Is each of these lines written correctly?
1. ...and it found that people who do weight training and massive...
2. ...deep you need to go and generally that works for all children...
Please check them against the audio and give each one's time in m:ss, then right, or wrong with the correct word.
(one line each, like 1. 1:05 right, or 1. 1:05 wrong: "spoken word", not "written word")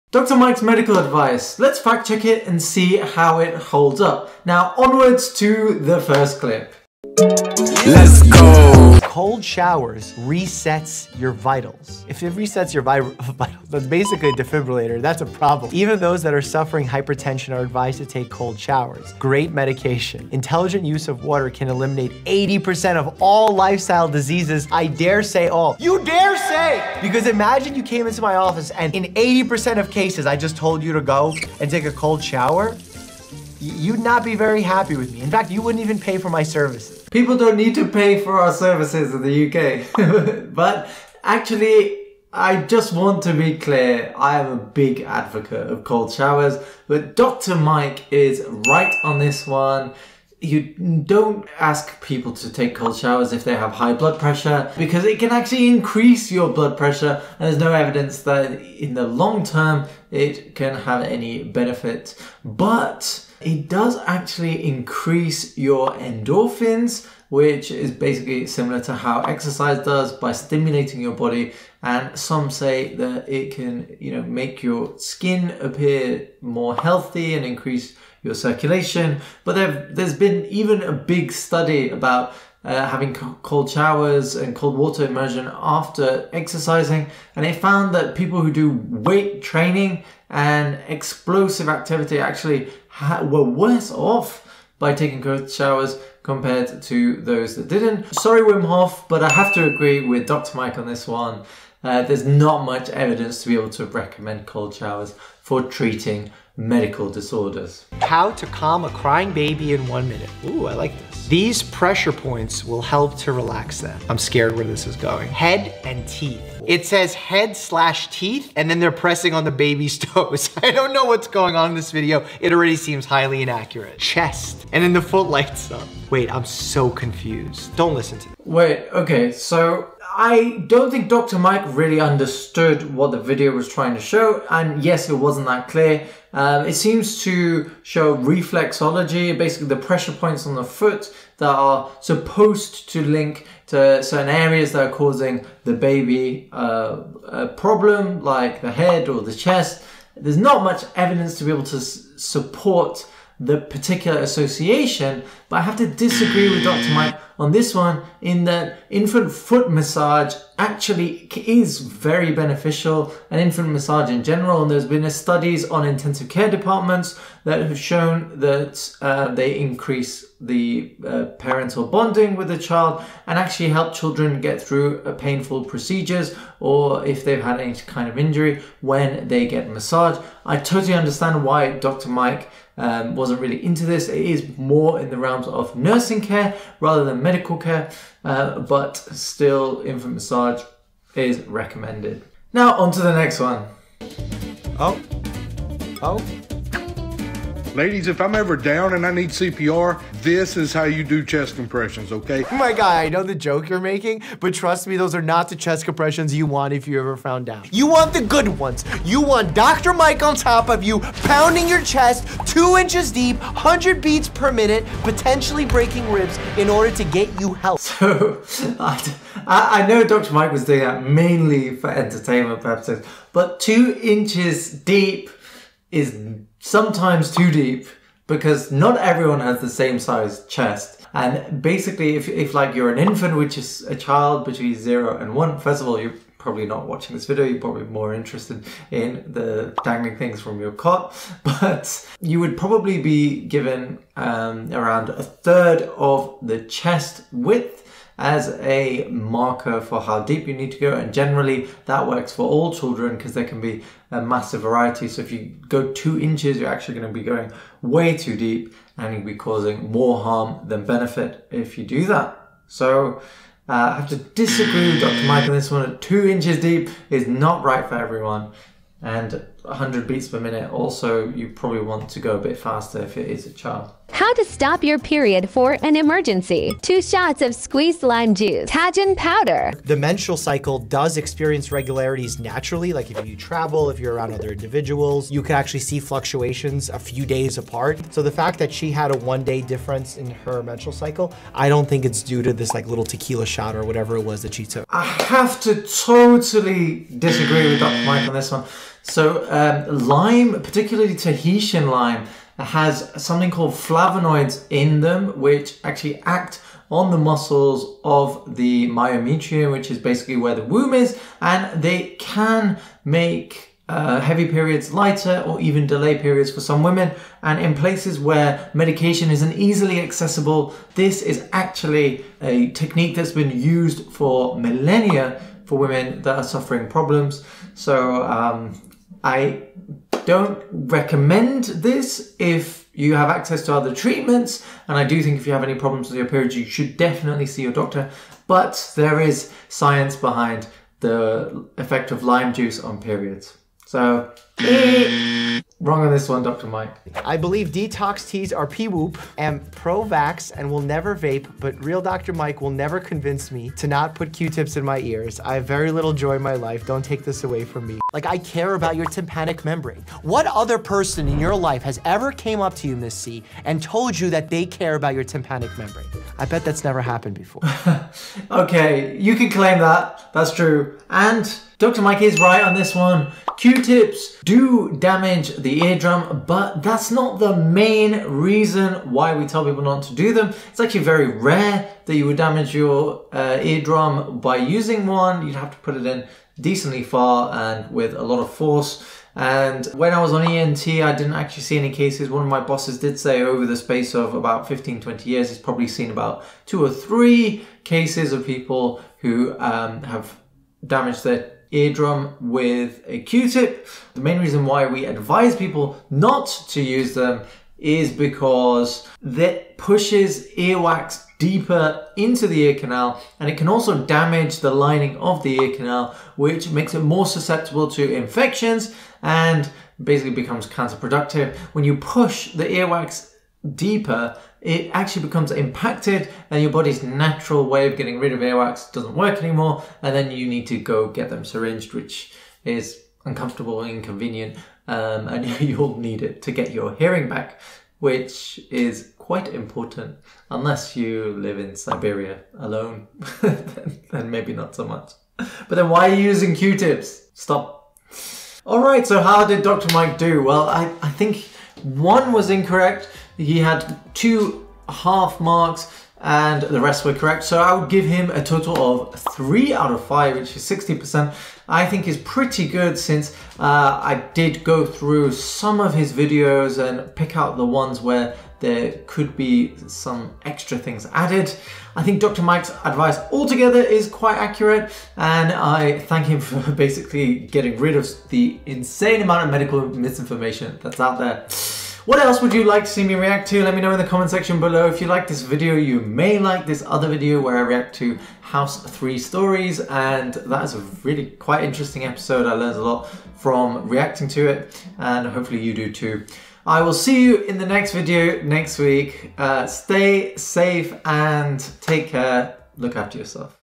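1. 1:27 wrong: "explosive", not "massive"
2. 4:10 right.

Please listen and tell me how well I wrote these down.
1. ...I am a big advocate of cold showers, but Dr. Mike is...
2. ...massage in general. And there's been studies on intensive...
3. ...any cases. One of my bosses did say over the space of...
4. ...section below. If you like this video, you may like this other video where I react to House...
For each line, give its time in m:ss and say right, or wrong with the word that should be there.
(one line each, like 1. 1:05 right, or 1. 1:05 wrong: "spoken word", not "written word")
1. 0:44 right
2. 2:43 right
3. 6:31 right
4. 8:04 right.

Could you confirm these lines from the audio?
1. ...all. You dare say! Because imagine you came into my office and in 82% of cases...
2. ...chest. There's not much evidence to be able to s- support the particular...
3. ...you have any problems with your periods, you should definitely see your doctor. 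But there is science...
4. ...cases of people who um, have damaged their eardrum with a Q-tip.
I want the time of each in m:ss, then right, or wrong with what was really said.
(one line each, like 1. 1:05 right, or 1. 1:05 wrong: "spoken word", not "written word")
1. 0:25 wrong: "80", not "82"
2. 2:29 right
3. 5:35 right
4. 6:37 right.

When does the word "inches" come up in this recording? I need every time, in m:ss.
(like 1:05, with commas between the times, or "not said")
3:32, 3:44, 4:16, 4:26.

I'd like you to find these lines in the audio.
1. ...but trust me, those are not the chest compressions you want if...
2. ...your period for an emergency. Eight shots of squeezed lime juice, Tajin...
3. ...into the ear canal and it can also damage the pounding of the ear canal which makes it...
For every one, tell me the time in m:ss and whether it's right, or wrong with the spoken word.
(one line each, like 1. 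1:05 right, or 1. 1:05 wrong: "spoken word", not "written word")
1. 3:24 right
2. 4:34 wrong: "Two", not "Eight"
3. 6:52 wrong: "lining", not "pounding".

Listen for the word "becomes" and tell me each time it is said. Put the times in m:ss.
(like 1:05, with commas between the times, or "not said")
7:00, 7:05.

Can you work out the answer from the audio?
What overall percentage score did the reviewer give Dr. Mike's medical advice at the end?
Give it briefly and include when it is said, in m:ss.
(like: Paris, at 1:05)
60%, at 7:40.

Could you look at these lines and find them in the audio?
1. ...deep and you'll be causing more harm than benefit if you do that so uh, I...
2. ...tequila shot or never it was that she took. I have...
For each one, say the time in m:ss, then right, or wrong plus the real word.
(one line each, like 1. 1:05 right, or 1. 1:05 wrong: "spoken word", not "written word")
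1. 4:18 right
2. 4:53 wrong: "whatever", not "never".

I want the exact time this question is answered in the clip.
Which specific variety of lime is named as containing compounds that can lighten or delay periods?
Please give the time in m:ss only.
5:01.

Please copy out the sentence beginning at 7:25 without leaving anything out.
But then why are you using Q-tips?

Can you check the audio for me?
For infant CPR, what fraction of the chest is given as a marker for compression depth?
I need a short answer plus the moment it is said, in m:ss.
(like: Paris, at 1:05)
a third, at 4:05.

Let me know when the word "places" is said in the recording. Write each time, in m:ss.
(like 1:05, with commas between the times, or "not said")
5:17.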